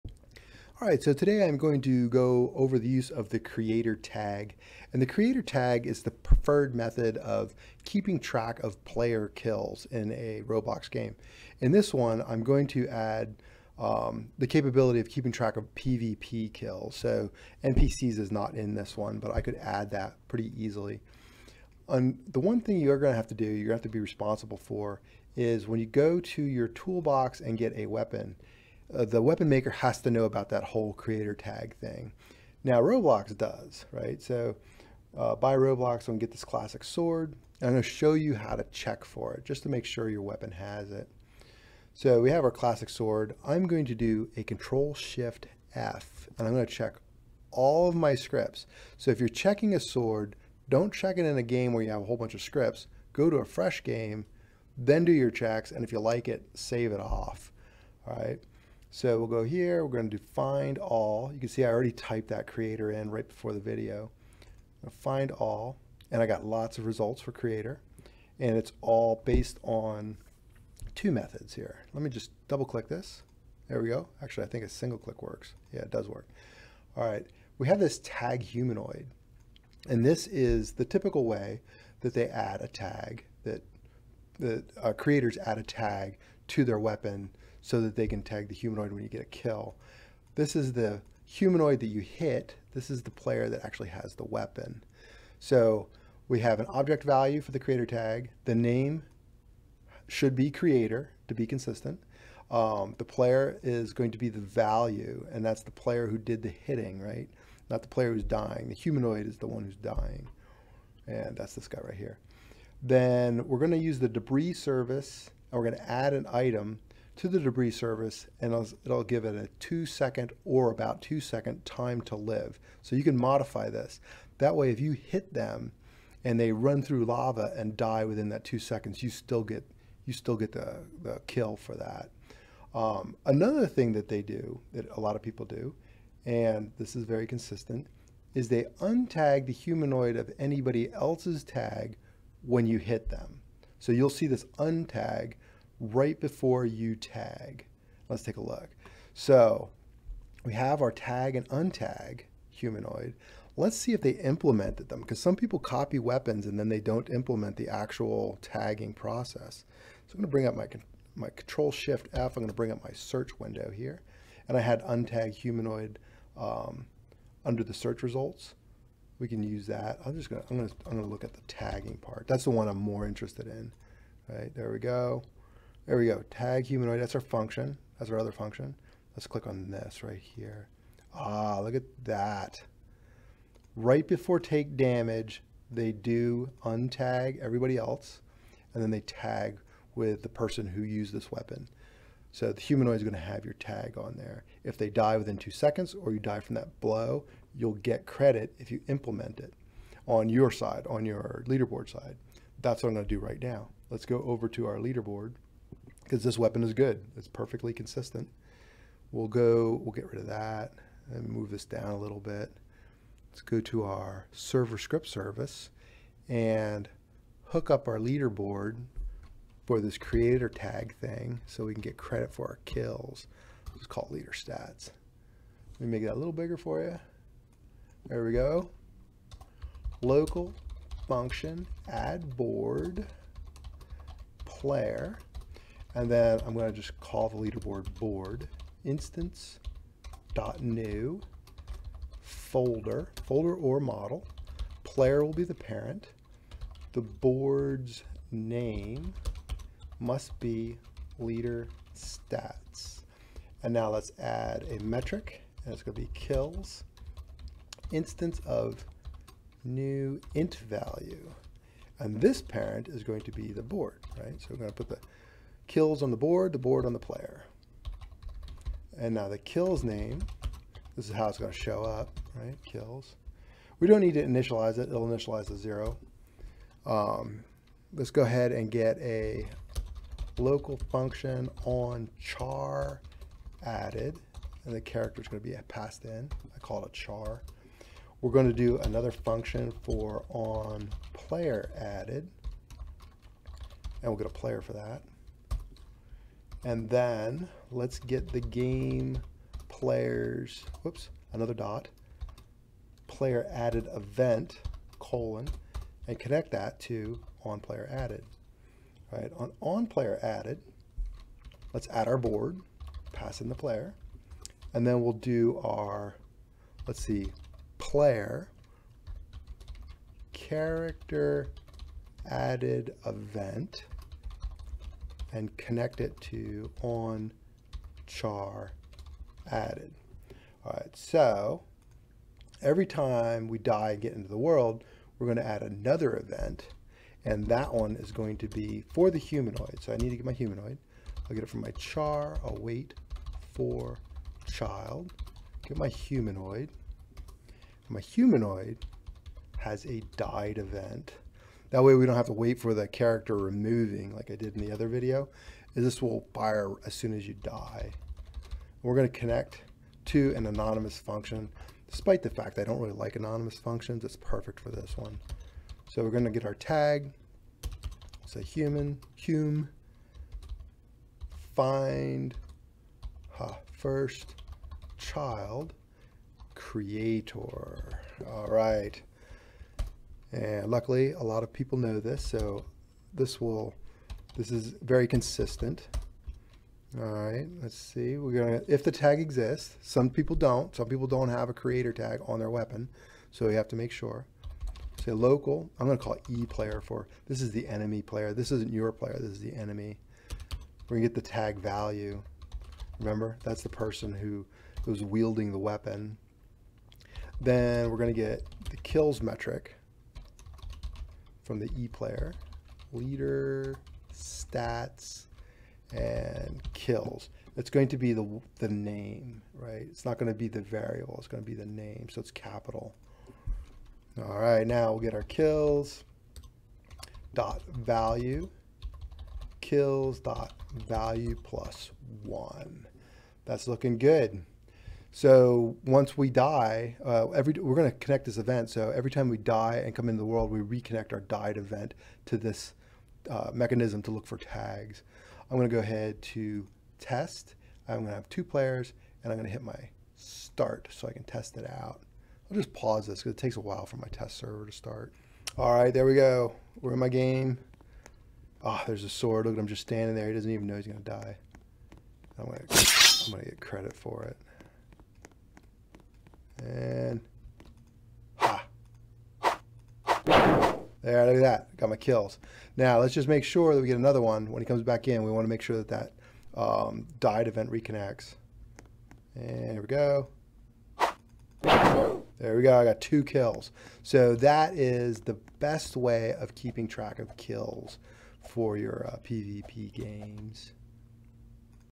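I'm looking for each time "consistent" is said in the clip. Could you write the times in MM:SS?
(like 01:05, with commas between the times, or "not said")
01:41, 02:17, 03:27, 06:25.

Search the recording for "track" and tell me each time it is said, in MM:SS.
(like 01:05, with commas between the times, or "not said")
00:08, 00:15, 08:06.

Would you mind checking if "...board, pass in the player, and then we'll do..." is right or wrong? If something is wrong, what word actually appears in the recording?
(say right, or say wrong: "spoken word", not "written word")
right.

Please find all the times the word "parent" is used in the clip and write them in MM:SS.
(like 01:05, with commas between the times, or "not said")
04:05, 04:22.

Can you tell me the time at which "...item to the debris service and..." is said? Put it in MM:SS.
01:56.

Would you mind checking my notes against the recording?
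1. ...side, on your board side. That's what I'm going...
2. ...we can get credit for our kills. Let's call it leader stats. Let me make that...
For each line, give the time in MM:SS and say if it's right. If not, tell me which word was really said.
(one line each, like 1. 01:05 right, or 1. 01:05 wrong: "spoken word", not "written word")
1. 03:20 wrong: "leaderboard", not "board"
2. 03:41 right.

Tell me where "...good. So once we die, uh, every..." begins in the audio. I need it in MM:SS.
07:13.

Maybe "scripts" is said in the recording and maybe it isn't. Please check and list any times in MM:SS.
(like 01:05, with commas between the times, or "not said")
00:48, 00:52, 03:34.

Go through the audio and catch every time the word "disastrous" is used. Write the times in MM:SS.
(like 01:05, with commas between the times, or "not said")
not said.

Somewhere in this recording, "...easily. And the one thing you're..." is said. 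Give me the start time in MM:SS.
00:20.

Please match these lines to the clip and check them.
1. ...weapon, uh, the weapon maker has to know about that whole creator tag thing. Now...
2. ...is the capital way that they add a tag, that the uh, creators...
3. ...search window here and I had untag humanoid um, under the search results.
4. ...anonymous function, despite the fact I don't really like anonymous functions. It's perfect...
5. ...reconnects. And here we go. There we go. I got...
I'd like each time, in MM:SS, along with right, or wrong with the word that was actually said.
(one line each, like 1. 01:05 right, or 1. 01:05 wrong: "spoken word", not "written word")
1. 00:27 right
2. 01:20 wrong: "typical", not "capital"
3. 02:42 right
4. 06:00 right
5. 07:57 right.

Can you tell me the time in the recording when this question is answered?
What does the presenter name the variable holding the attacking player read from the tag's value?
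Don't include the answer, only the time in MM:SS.
06:36.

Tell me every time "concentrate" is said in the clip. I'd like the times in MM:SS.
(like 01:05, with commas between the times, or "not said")
not said.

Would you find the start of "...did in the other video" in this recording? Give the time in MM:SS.
05:54.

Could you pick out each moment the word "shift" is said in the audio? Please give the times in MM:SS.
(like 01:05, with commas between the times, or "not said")
00:44, 02:41.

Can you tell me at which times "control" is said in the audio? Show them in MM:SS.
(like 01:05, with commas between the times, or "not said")
00:44, 02:41.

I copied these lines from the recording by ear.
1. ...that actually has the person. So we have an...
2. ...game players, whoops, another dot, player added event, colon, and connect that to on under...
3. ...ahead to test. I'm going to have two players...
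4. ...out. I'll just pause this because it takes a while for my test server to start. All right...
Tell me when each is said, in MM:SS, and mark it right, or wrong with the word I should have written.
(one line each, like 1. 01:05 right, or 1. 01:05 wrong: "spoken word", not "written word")
1. 01:33 wrong: "weapon", not "person"
2. 04:58 wrong: "player", not "under"
3. 07:25 right
4. 07:31 right.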